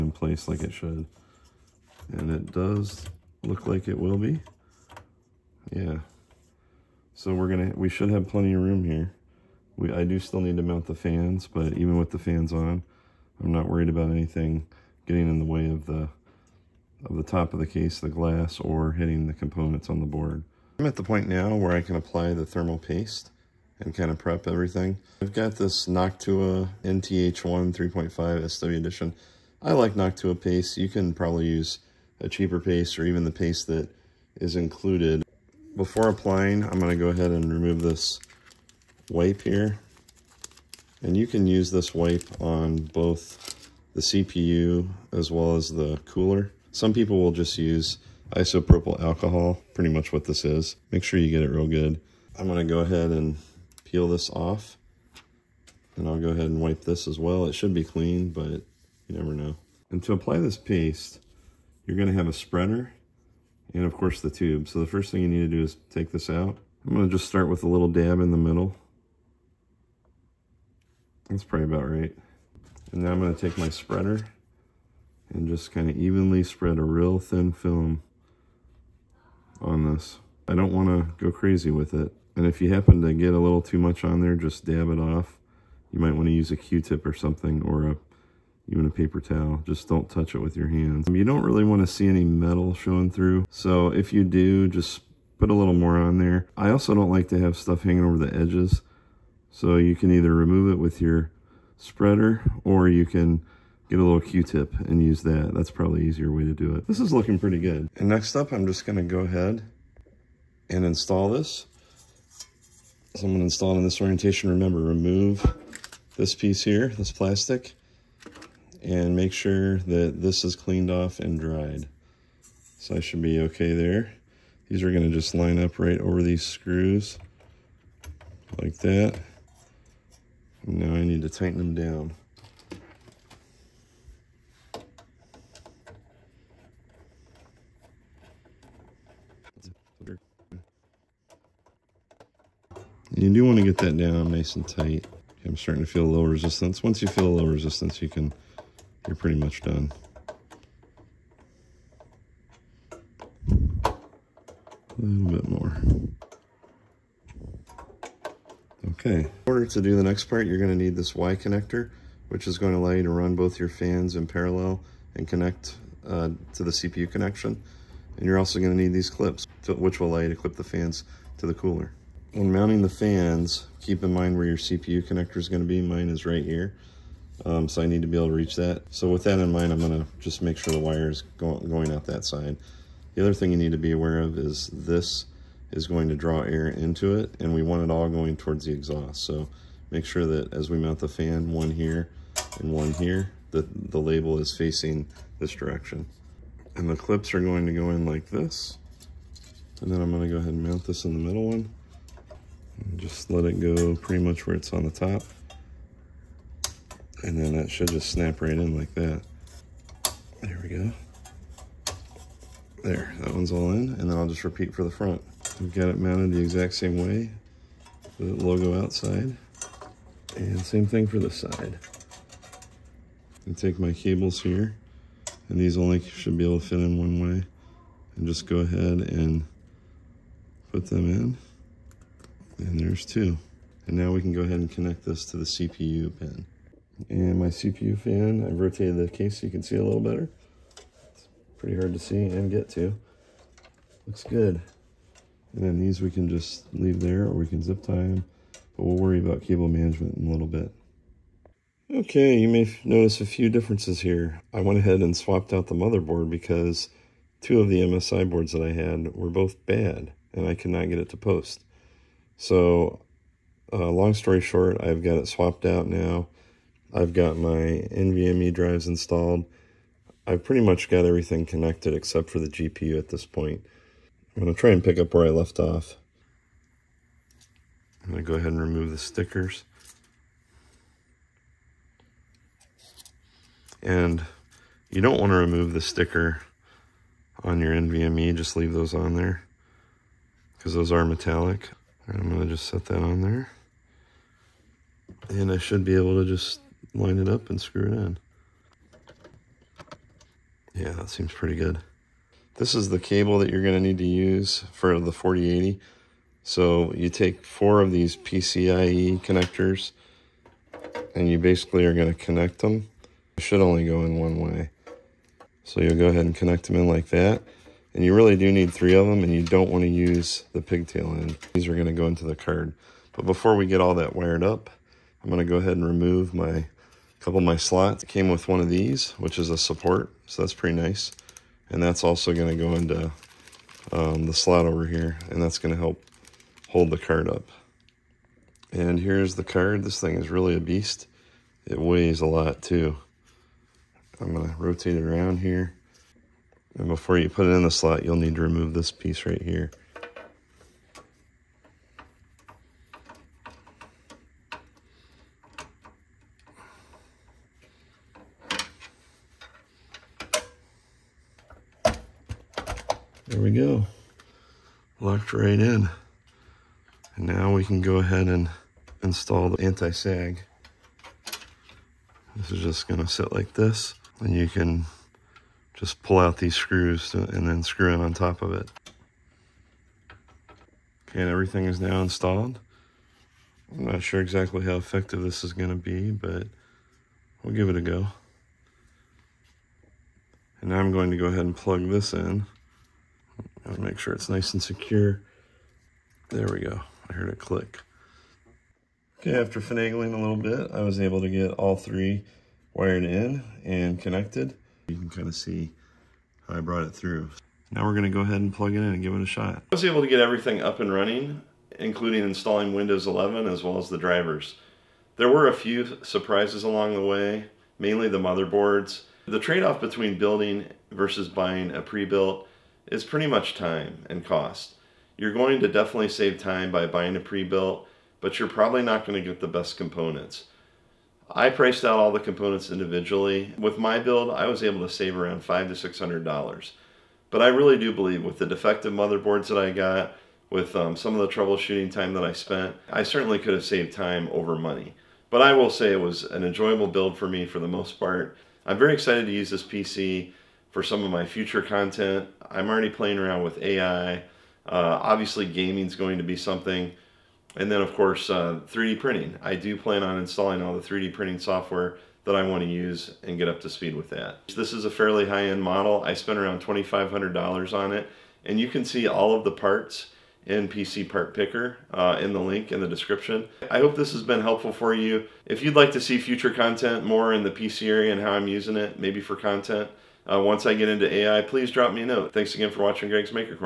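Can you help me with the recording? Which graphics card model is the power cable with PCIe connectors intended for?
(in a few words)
4080.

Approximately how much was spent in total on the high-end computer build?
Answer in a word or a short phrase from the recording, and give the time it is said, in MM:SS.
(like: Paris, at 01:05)
$2,500, at 07:46.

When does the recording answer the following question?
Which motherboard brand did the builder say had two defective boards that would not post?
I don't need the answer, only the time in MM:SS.
04:17.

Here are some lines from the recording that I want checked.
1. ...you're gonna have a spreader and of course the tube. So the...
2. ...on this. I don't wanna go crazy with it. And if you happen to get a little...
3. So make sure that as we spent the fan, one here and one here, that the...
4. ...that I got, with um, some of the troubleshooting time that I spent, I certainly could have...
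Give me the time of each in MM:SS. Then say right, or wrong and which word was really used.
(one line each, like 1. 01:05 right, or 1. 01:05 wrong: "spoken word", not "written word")
1. 01:01 right
2. 01:19 right
3. 03:09 wrong: "mount", not "spent"
4. 07:19 right.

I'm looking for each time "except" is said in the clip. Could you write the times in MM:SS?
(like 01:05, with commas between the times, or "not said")
04:31.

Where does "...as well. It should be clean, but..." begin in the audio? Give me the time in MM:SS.
00:57.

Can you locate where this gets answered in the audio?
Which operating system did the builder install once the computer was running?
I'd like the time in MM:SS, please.
06:52.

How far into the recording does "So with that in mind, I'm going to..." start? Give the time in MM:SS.
02:58.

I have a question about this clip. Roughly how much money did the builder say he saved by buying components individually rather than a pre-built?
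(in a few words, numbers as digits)
$500 to $600.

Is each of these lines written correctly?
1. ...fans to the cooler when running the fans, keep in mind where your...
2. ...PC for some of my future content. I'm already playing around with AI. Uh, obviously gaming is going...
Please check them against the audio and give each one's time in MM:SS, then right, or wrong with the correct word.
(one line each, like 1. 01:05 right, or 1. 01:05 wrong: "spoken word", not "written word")
1. 02:50 wrong: "mounting", not "running"
2. 07:29 right.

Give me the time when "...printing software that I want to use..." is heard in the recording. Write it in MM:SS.
07:41.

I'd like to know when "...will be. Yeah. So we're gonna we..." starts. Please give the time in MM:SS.
00:03.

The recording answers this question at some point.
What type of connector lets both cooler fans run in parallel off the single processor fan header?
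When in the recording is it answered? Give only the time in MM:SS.
02:41.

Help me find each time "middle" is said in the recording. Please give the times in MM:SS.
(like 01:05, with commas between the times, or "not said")
01:08, 03:21.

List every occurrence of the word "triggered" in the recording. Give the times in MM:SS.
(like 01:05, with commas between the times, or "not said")
not said.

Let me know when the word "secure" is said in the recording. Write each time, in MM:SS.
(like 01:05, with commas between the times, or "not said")
06:34.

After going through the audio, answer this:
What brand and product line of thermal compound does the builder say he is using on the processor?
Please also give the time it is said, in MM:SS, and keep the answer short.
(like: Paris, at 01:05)
Noctua NTH1, at 00:25.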